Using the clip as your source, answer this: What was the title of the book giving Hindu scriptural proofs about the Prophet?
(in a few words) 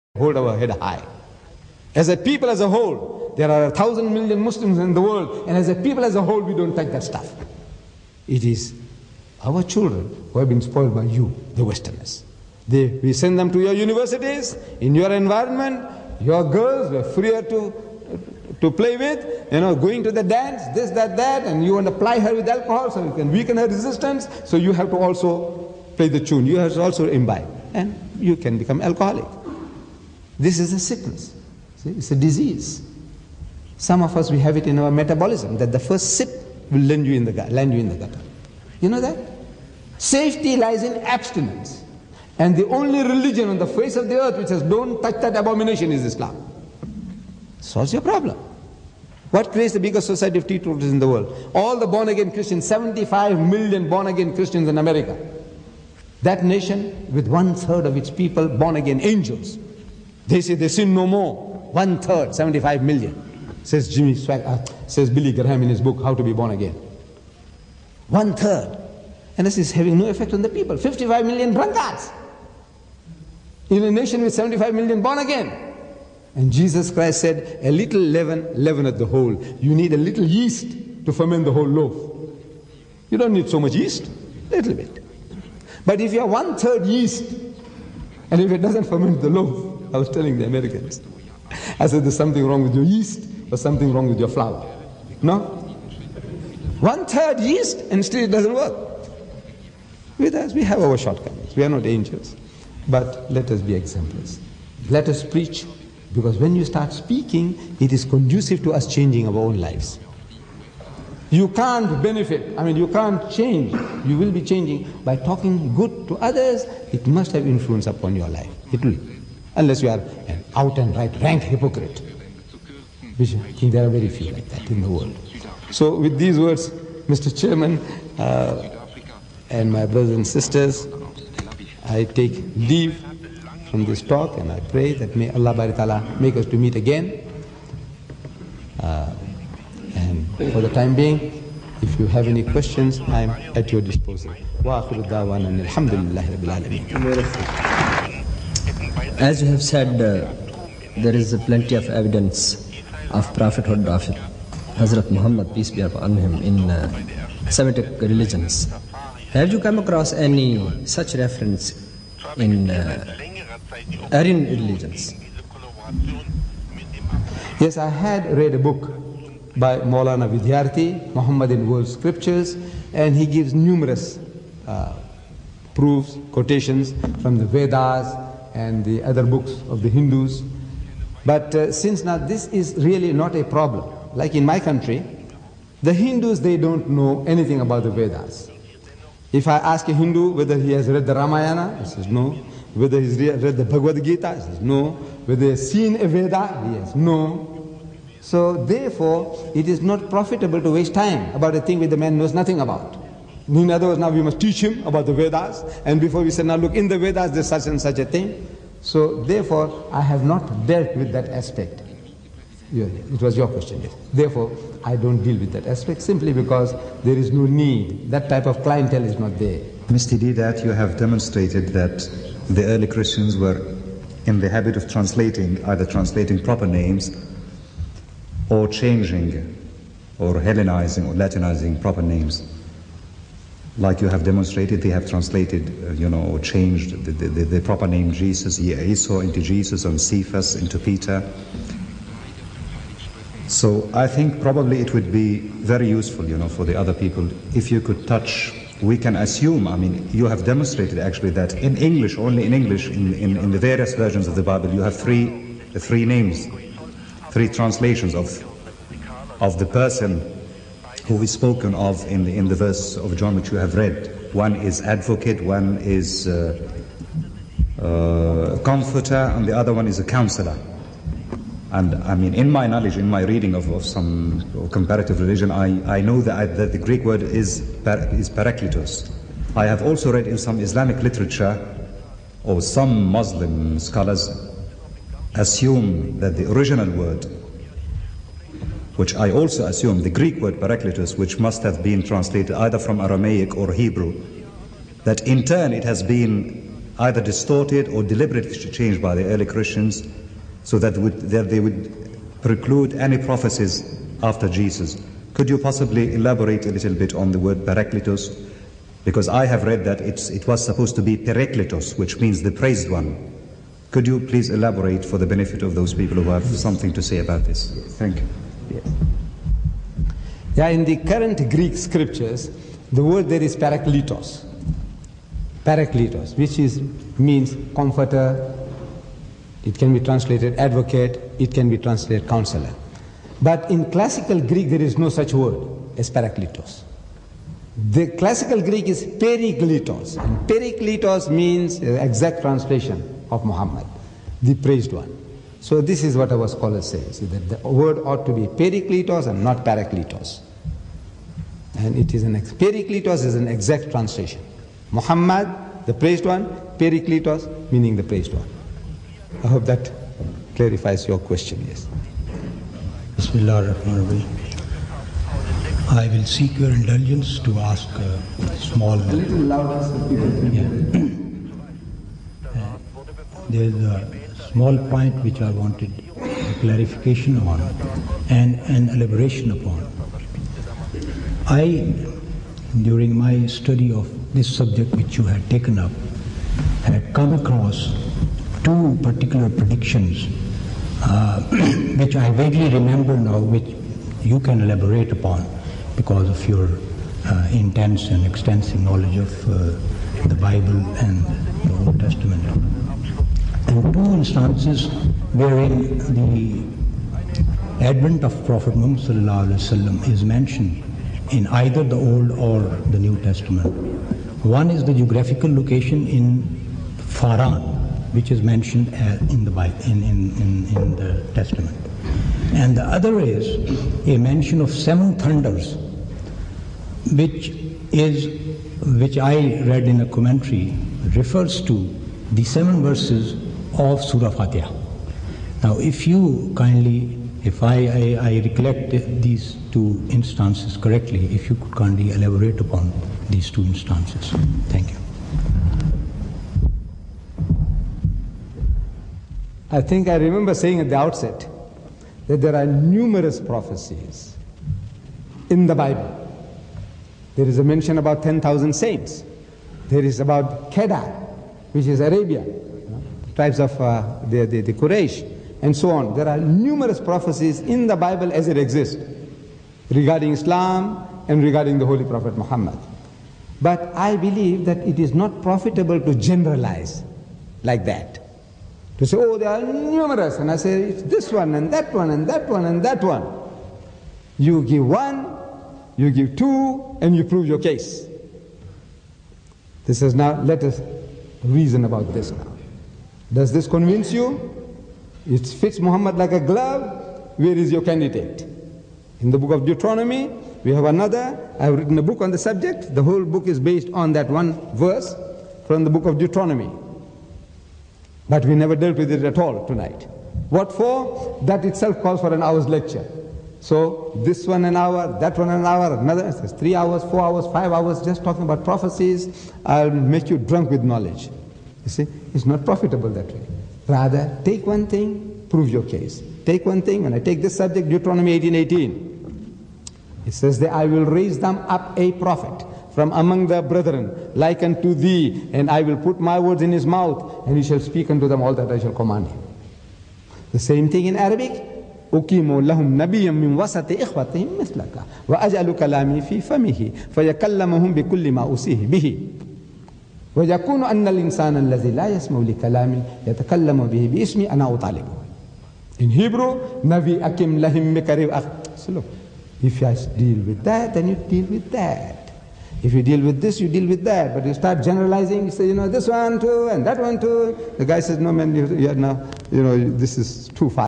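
Muhammad in World Scriptures.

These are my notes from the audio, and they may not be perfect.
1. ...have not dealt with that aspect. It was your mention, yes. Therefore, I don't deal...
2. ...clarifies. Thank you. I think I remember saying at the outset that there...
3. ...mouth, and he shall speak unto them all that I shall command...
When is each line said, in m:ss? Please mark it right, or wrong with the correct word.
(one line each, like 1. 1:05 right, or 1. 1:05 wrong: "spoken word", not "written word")
1. 3:30 wrong: "question", not "mention"
2. 7:23 wrong: "instances", not "clarifies"
3. 8:56 right.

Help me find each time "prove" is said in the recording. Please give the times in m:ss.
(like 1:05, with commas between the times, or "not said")
8:07, 8:45.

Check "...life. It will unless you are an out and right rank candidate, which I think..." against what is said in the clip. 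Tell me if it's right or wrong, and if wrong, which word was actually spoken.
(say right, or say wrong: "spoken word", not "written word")
wrong: "hypocrite", not "candidate".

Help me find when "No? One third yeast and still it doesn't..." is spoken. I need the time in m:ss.
1:35.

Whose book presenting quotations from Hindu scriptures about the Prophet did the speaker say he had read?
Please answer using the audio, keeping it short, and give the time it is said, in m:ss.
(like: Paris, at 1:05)
Maulana Vidyarthi, at 2:49.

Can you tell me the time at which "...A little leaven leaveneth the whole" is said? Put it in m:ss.
1:17.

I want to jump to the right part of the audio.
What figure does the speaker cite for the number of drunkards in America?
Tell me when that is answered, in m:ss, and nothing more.
1:10.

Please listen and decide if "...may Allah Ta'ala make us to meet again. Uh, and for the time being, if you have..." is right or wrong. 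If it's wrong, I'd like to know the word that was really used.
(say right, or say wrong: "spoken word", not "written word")
right.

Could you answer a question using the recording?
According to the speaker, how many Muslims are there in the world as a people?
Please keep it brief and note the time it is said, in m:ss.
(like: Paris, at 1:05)
1,000,000,000, at 0:03.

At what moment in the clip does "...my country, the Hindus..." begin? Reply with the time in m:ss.
3:04.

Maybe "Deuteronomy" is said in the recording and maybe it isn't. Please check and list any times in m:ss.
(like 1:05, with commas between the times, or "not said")
8:19, 8:26, 8:47.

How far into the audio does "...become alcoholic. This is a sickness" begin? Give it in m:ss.
0:28.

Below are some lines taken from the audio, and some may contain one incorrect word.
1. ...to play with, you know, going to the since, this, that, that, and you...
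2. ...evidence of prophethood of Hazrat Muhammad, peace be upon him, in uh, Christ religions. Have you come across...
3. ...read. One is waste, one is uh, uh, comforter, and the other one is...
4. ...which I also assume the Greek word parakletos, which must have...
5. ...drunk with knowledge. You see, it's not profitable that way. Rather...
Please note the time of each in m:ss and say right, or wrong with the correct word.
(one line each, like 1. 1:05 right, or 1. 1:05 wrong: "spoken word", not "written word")
1. 0:18 wrong: "dance", not "since"
2. 2:31 wrong: "Semitic", not "Christ"
3. 4:23 wrong: "advocate", not "waste"
4. 4:49 right
5. 8:40 right.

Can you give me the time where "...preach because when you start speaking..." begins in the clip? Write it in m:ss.
1:45.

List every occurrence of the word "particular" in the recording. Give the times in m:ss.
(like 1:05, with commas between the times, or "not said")
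6:29.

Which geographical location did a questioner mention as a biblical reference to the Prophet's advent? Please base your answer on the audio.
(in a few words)
Faran.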